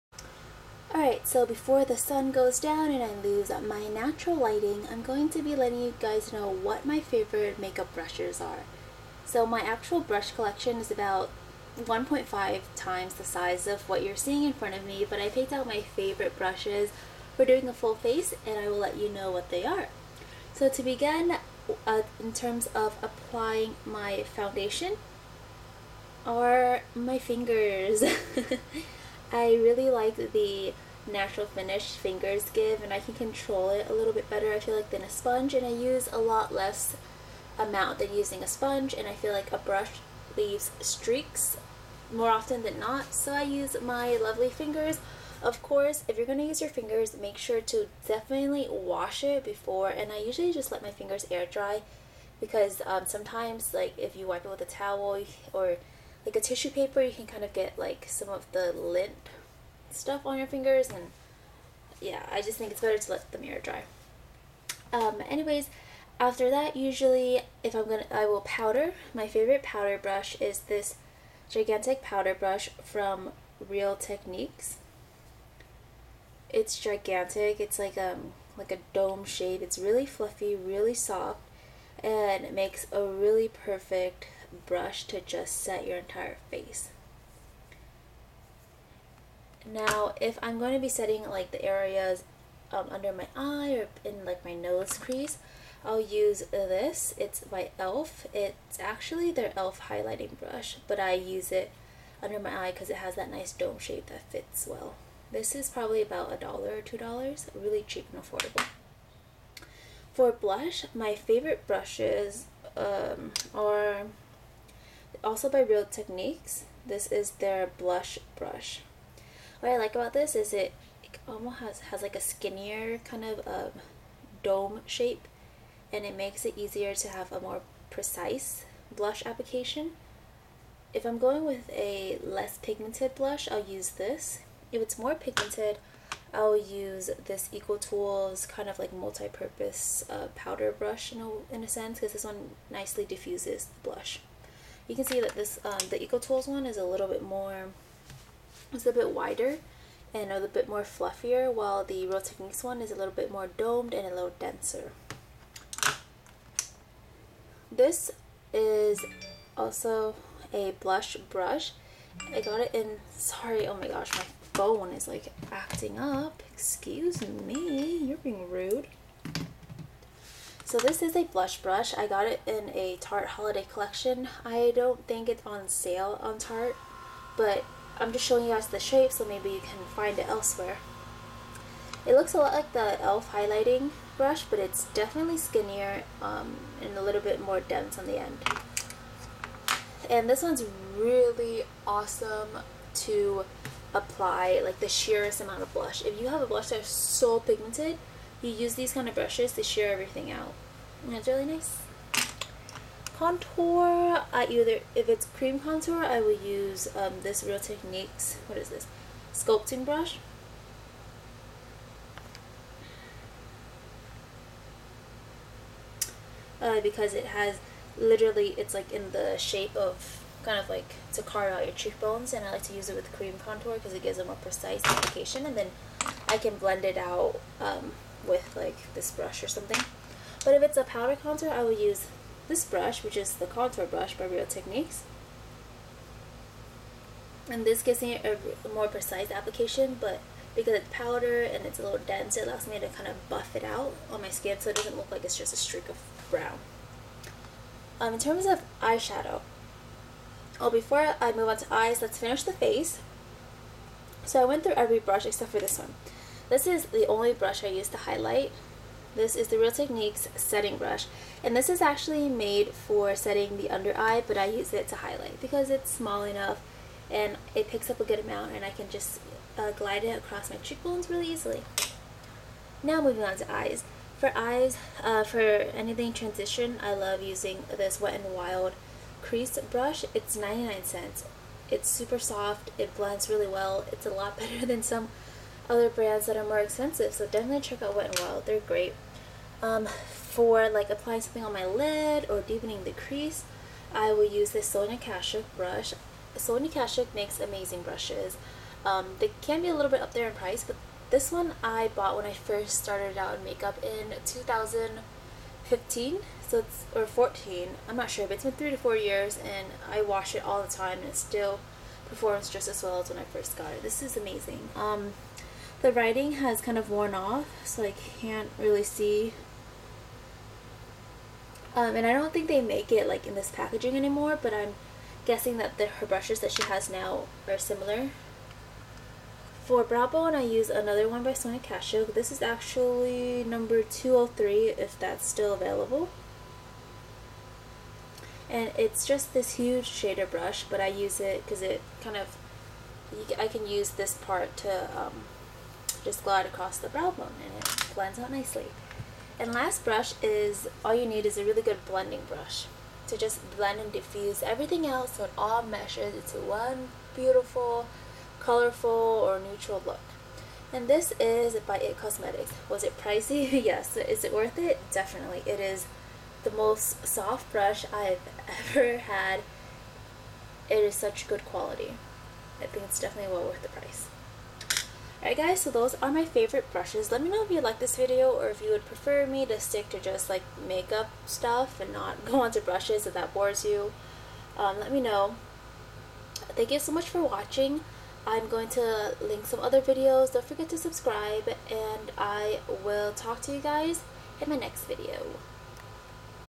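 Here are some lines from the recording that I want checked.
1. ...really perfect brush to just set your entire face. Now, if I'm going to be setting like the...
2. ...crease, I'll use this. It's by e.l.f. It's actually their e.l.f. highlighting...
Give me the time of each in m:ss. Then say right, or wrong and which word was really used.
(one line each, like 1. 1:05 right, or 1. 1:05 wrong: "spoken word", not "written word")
1. 1:23 right
2. 1:34 right.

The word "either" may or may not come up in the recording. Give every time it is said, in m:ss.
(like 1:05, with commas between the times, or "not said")
3:24.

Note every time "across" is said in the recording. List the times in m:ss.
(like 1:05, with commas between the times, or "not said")
4:30, 5:46.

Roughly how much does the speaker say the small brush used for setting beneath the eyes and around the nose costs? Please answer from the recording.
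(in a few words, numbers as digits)
a dollar or two dollars.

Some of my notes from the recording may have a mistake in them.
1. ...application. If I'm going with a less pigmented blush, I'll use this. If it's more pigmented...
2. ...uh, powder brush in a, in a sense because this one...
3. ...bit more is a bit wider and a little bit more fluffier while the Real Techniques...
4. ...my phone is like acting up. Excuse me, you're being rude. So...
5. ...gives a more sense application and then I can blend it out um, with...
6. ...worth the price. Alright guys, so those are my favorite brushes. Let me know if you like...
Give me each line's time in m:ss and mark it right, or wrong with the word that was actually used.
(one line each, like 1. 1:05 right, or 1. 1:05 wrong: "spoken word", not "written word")
1. 2:09 right
2. 2:20 right
3. 2:27 right
4. 2:44 right
5. 3:44 wrong: "precise", not "sense"
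6. 6:13 right.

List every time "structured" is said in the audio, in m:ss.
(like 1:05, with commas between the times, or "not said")
not said.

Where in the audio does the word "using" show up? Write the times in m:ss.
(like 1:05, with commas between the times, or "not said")
0:38, 4:37.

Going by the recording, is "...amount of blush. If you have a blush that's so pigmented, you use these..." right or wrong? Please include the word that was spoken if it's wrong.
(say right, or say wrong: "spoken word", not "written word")
right.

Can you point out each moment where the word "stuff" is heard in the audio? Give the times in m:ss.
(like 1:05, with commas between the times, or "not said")
0:59, 6:21.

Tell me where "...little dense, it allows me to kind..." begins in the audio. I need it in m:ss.
4:01.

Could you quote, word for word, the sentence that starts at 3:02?
It looks a lot like the e.l.f.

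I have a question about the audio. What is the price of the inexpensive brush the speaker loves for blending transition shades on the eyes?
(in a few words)
99 cents.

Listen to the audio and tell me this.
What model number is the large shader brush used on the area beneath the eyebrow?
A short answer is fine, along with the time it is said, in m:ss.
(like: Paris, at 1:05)
203, at 5:33.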